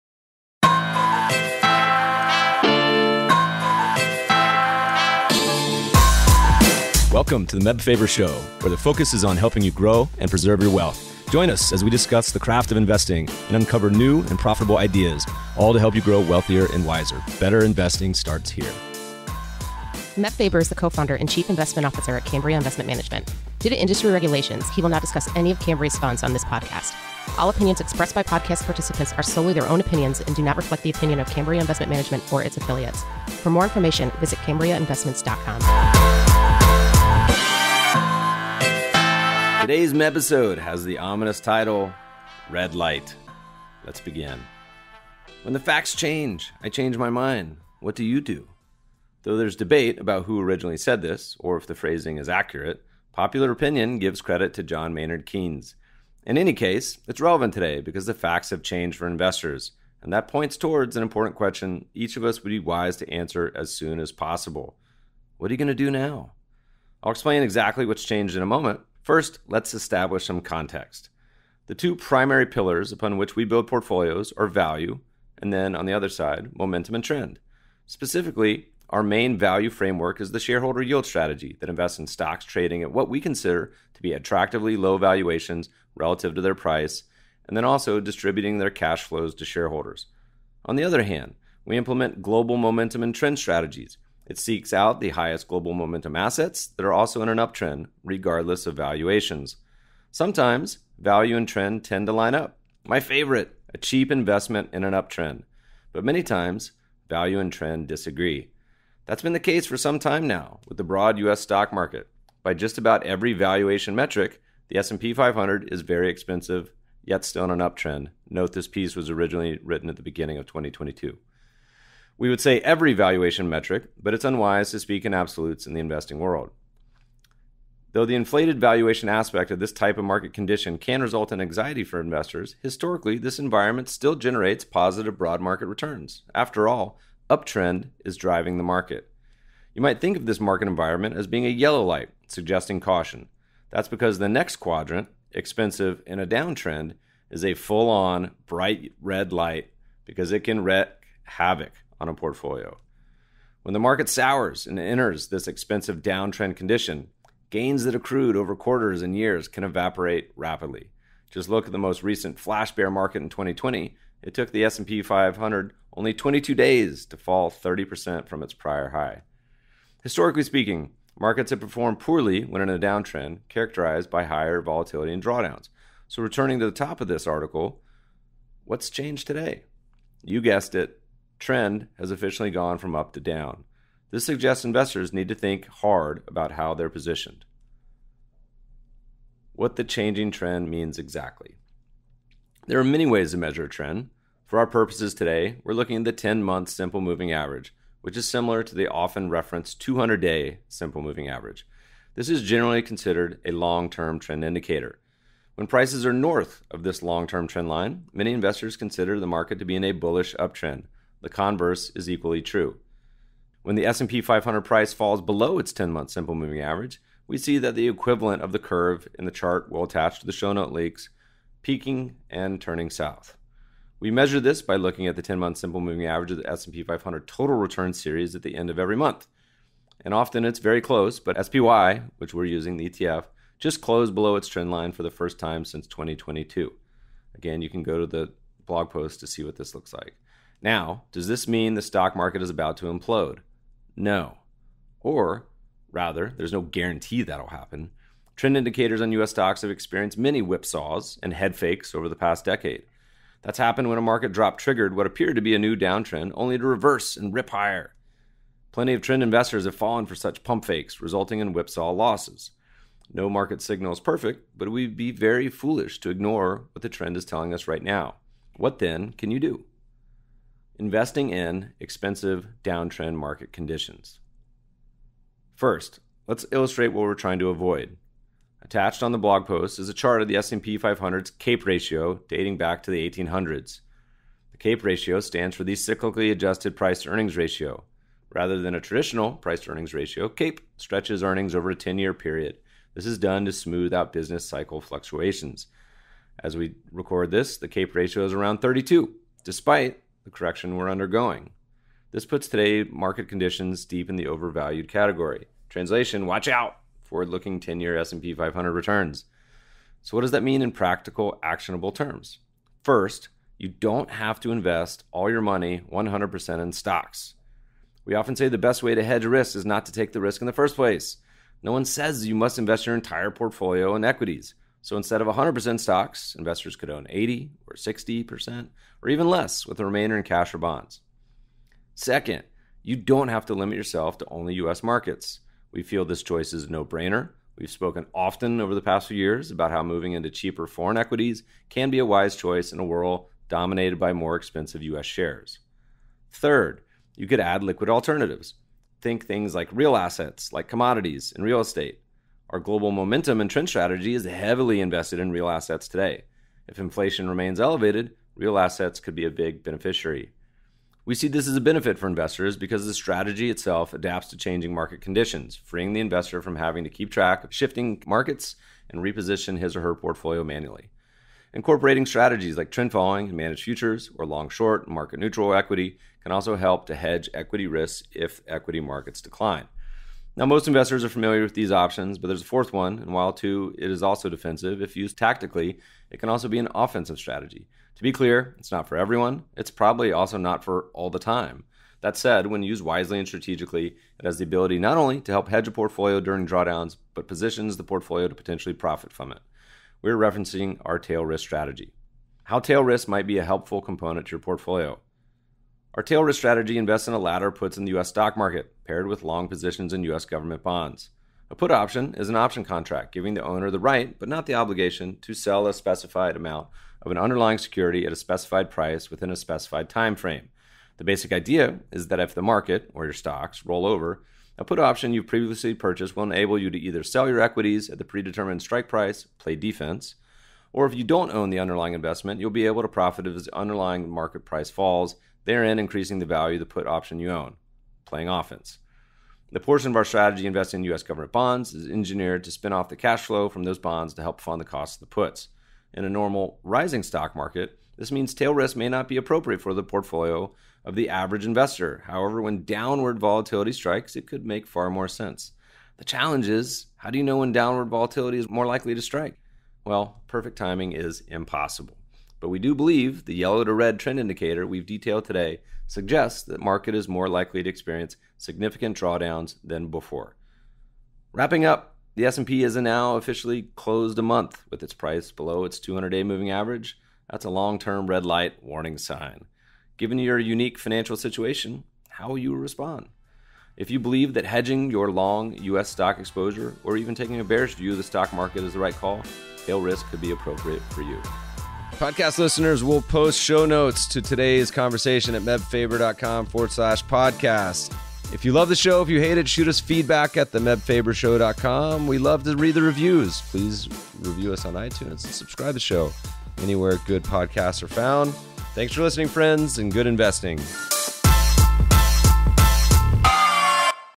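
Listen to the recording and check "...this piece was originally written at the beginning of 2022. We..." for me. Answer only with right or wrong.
right.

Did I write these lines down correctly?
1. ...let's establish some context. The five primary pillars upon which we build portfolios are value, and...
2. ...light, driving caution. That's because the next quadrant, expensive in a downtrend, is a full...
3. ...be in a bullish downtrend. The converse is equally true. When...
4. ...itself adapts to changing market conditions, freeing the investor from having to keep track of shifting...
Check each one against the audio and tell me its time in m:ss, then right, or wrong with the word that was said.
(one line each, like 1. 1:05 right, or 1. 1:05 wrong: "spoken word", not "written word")
1. 1:09 wrong: "two", not "five"
2. 2:21 wrong: "suggesting", not "driving"
3. 3:29 wrong: "uptrend", not "downtrend"
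4. 6:03 right.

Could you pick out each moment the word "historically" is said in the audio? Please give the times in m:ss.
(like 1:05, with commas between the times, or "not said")
2:12, 2:50.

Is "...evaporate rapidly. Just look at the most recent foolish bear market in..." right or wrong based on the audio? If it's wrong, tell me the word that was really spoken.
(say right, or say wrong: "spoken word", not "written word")
wrong: "flash", not "foolish".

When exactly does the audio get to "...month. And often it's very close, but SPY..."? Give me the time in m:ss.
3:48.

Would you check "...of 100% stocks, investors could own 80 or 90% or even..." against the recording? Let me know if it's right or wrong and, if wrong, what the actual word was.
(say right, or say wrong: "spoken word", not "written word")
wrong: "60", not "90".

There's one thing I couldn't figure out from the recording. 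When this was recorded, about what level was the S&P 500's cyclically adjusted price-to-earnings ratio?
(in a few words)
32.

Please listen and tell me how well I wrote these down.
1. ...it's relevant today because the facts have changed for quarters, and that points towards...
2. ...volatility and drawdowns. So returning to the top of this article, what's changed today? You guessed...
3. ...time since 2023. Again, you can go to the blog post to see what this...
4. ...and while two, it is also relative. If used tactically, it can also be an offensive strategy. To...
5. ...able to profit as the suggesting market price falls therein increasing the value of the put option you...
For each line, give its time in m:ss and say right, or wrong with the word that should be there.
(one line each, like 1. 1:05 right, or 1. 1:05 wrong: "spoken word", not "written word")
1. 0:57 wrong: "investors", not "quarters"
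2. 2:54 right
3. 3:55 wrong: "2022", not "2023"
4. 6:22 wrong: "defensive", not "relative"
5. 7:12 wrong: "underlying", not "suggesting".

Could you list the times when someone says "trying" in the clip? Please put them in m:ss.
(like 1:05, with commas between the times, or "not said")
4:37.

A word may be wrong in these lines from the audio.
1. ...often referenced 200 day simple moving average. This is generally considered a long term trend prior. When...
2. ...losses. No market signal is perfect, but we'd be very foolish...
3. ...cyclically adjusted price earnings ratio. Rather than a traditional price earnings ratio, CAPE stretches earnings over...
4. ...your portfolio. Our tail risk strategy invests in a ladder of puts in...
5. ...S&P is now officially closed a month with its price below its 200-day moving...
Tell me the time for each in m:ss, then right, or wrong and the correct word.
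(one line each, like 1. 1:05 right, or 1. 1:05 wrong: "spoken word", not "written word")
1. 3:18 wrong: "indicator", not "prior"
2. 4:21 right
3. 4:45 right
4. 6:44 right
5. 7:52 right.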